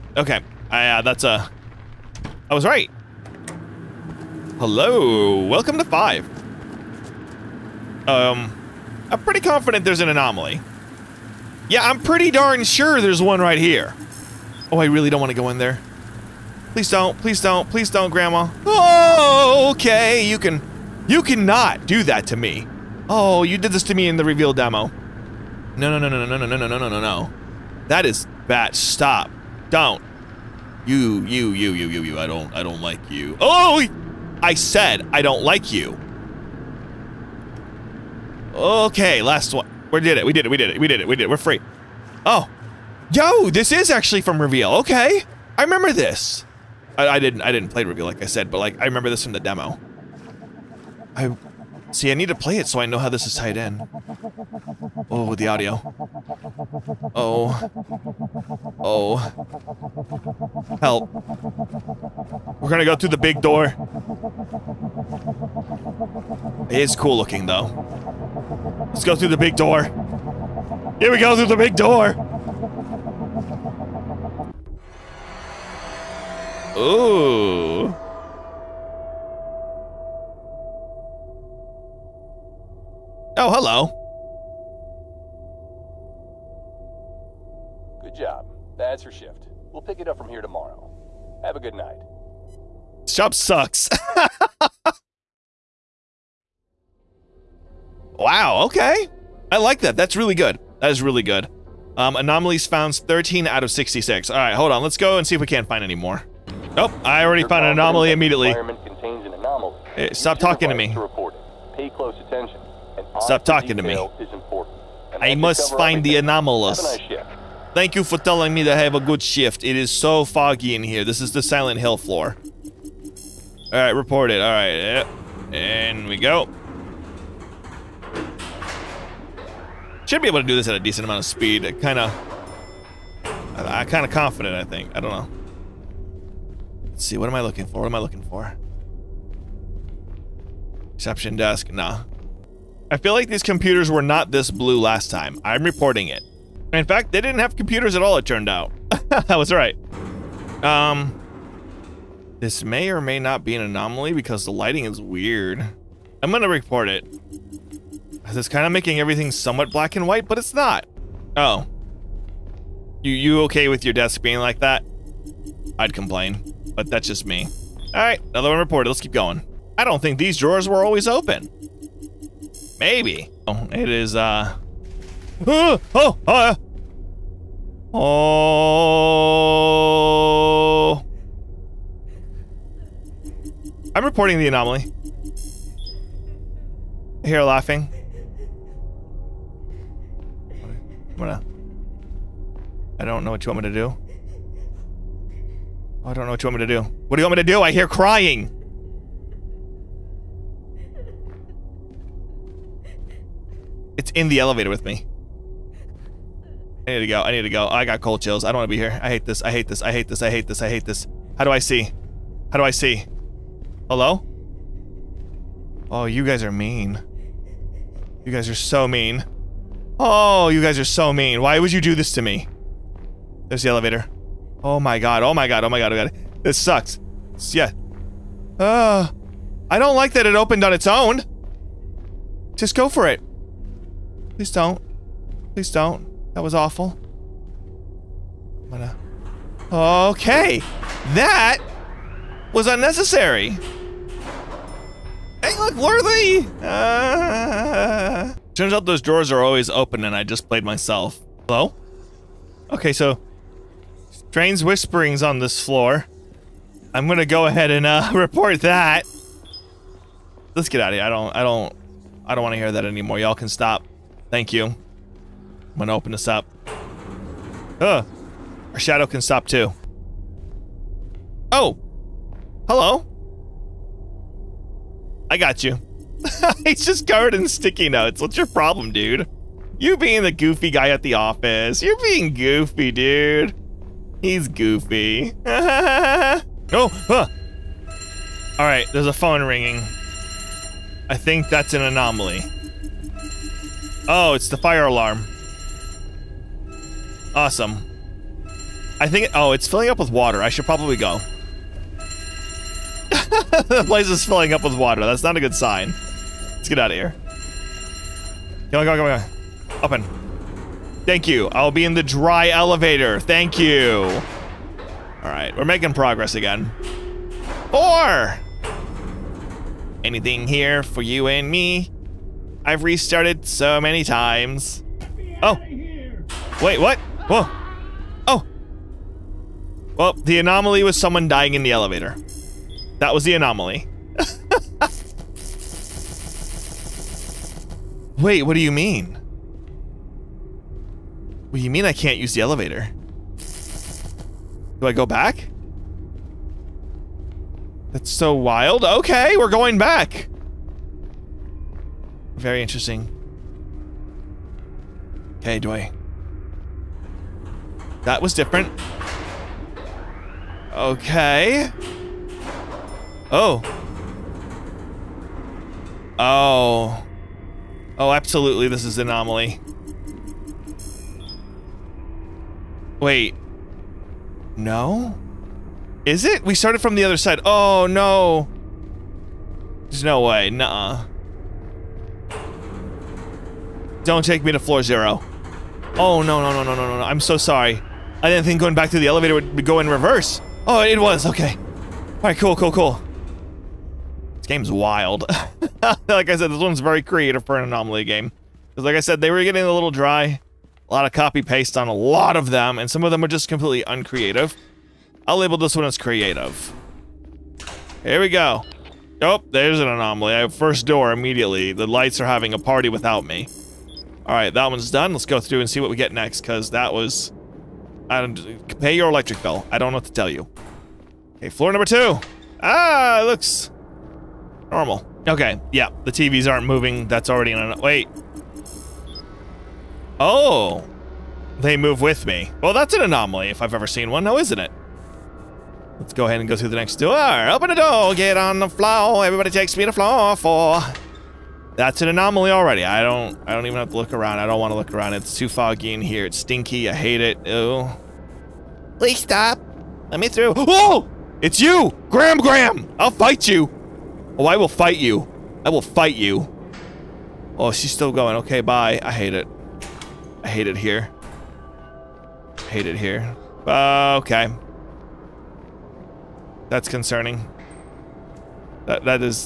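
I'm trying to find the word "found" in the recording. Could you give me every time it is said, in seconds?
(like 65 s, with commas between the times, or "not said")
102 s, 107 s.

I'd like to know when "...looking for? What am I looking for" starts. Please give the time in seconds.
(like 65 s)
137 s.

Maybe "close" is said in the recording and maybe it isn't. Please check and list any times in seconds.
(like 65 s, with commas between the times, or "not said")
111 s.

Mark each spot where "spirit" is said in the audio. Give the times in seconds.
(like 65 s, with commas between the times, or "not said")
not said.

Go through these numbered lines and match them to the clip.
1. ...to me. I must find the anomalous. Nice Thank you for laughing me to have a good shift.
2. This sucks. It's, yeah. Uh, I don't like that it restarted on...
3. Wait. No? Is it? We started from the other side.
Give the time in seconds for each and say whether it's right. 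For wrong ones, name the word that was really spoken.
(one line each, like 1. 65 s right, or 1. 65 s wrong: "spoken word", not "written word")
1. 113 s wrong: "telling", not "laughing"
2. 226 s wrong: "opened", not "restarted"
3. 372 s right.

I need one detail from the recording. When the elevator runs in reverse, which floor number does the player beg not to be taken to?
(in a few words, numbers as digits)
floor zero.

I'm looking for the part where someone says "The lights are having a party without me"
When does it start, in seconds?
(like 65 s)
411 s.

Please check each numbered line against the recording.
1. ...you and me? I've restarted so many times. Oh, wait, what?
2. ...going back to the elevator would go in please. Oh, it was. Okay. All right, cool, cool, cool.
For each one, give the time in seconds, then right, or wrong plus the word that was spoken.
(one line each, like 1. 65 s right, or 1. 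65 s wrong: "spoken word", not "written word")
1. 321 s right
2. 388 s wrong: "reverse", not "please".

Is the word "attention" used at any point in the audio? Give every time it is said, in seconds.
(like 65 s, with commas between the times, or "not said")
112 s.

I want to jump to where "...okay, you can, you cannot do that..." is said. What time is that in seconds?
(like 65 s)
19 s.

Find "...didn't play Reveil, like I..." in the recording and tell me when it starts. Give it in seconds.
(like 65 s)
47 s.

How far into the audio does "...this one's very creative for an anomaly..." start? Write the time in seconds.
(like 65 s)
396 s.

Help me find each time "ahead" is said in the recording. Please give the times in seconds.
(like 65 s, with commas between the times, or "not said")
257 s, 436 s.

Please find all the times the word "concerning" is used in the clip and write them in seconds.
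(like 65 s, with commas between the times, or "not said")
466 s.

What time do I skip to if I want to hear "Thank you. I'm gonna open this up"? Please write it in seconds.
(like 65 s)
264 s.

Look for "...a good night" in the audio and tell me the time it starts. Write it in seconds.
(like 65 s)
91 s.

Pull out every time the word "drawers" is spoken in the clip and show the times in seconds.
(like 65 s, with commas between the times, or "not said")
170 s, 249 s.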